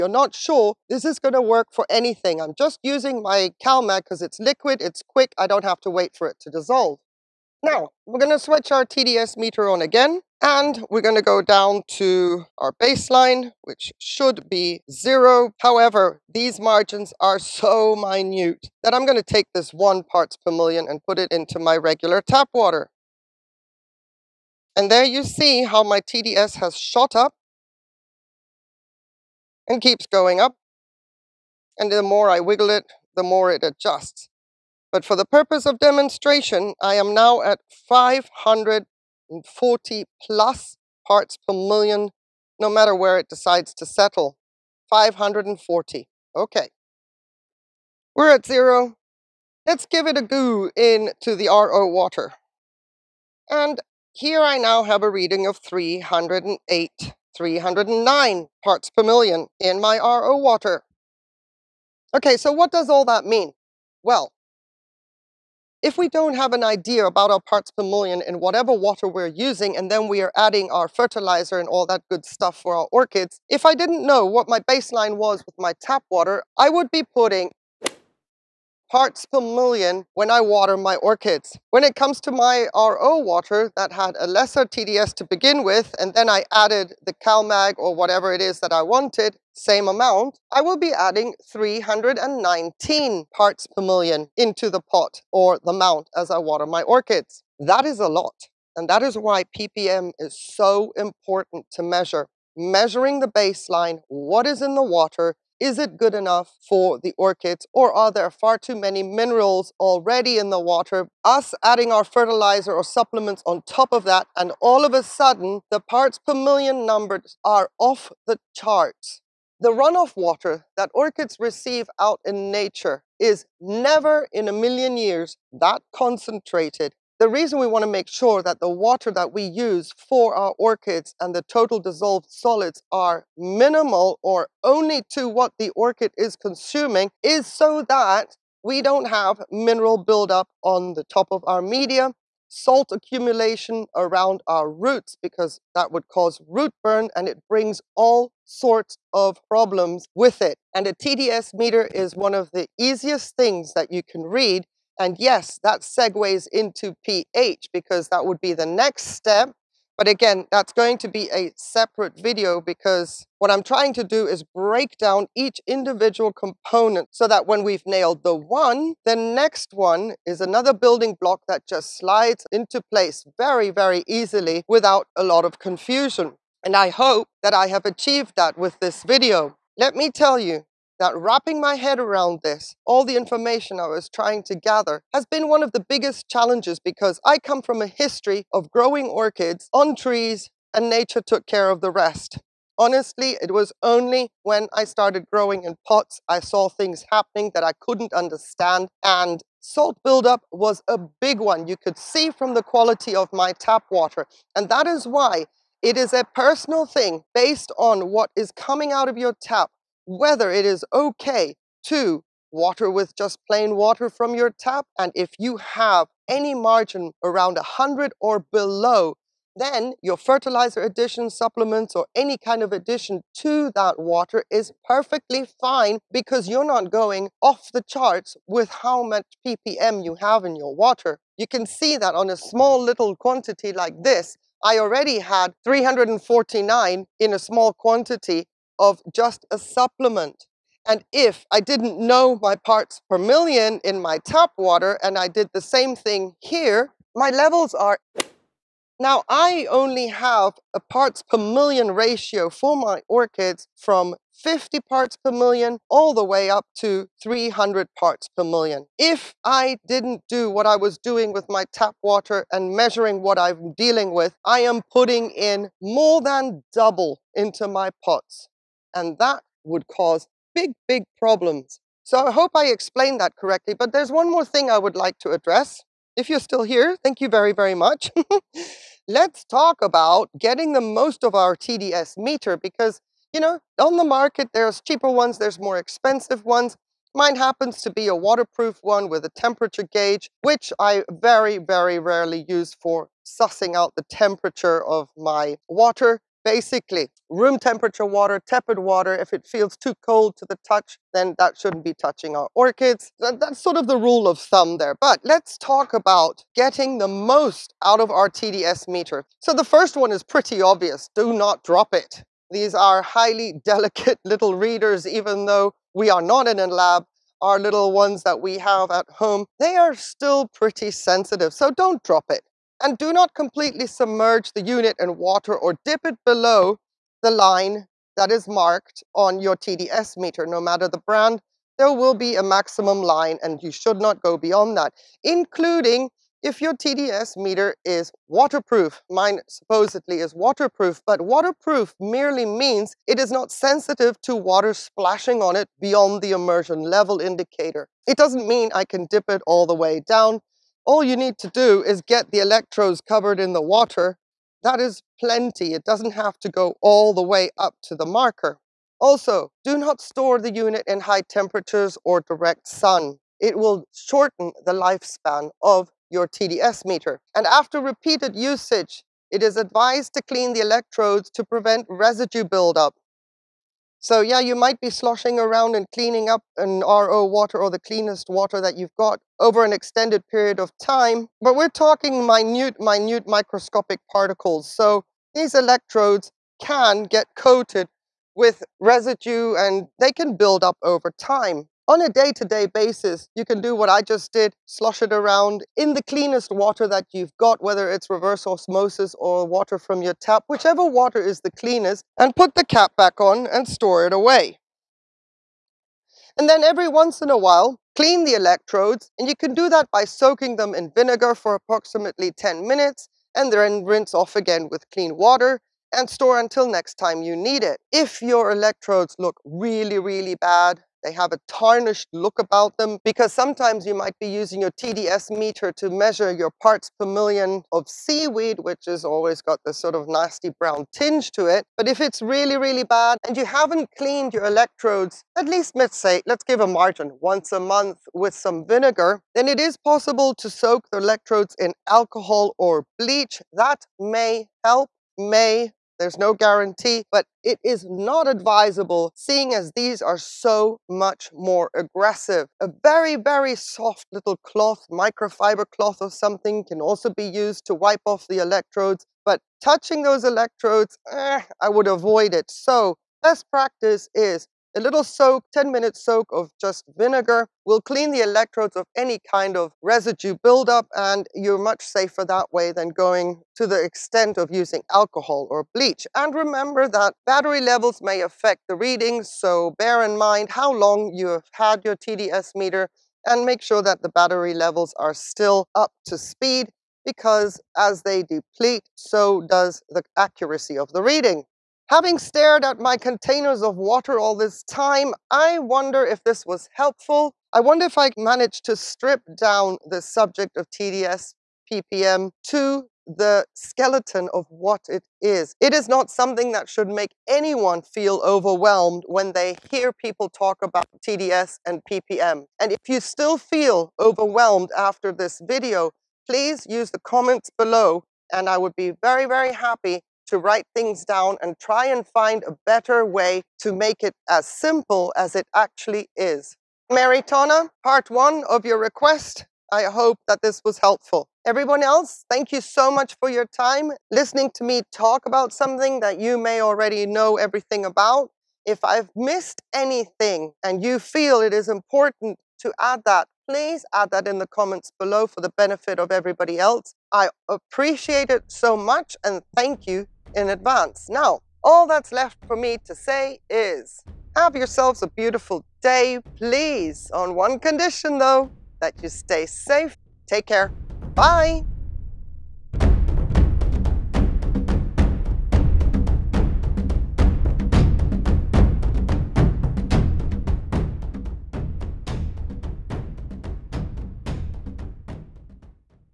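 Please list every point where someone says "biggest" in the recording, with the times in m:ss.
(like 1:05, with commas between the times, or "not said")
3:05.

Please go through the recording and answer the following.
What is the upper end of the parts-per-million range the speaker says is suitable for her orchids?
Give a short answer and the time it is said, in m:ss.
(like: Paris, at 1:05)
300 parts per million, at 4:17.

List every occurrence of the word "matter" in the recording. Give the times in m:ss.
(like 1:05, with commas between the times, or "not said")
0:42, 5:30.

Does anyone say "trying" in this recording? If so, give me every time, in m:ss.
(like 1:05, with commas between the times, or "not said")
2:43, 3:04.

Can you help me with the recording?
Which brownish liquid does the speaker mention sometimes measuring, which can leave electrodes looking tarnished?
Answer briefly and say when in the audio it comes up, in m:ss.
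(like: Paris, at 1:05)
seaweed, at 7:07.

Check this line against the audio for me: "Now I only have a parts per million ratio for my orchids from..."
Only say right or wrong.
right.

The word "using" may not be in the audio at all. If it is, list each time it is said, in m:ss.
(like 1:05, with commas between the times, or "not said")
0:02, 1:09, 7:04, 7:54.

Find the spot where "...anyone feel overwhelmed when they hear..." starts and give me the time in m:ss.
8:27.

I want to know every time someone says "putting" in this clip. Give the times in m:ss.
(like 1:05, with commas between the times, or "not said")
1:17, 4:24.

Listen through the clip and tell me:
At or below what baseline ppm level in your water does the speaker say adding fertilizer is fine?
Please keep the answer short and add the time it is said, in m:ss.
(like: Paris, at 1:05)
100, at 3:37.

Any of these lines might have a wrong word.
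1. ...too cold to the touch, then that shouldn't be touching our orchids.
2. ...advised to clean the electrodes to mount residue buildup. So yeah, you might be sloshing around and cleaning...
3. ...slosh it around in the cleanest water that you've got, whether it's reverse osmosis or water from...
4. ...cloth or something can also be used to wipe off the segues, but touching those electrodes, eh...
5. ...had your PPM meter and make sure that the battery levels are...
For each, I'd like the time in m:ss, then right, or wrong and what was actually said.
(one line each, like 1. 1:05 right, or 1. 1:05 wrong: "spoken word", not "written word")
1. 4:59 right
2. 6:09 wrong: "prevent", not "mount"
3. 6:34 right
4. 7:35 wrong: "electrodes", not "segues"
5. 8:01 wrong: "TDS", not "PPM".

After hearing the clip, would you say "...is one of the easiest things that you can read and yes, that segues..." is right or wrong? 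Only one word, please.
right.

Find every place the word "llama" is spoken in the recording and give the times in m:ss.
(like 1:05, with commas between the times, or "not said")
not said.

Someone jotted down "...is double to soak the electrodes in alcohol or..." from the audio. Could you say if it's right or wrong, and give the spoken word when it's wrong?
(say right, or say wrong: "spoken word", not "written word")
wrong: "possible", not "double".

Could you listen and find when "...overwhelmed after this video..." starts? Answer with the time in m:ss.
8:33.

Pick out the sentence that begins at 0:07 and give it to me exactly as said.
Now, we're going to switch our TDS meter on again.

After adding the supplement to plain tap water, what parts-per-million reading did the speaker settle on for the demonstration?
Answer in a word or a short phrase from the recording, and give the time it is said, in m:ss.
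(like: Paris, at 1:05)
540, at 0:44.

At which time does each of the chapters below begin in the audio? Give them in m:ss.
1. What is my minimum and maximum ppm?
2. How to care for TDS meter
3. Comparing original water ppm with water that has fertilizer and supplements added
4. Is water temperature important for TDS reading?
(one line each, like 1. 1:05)
1. 4:08
2. 5:04
3. 1:06
4. 4:52.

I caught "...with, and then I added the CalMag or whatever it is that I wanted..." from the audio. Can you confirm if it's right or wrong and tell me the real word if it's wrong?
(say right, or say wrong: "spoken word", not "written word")
right.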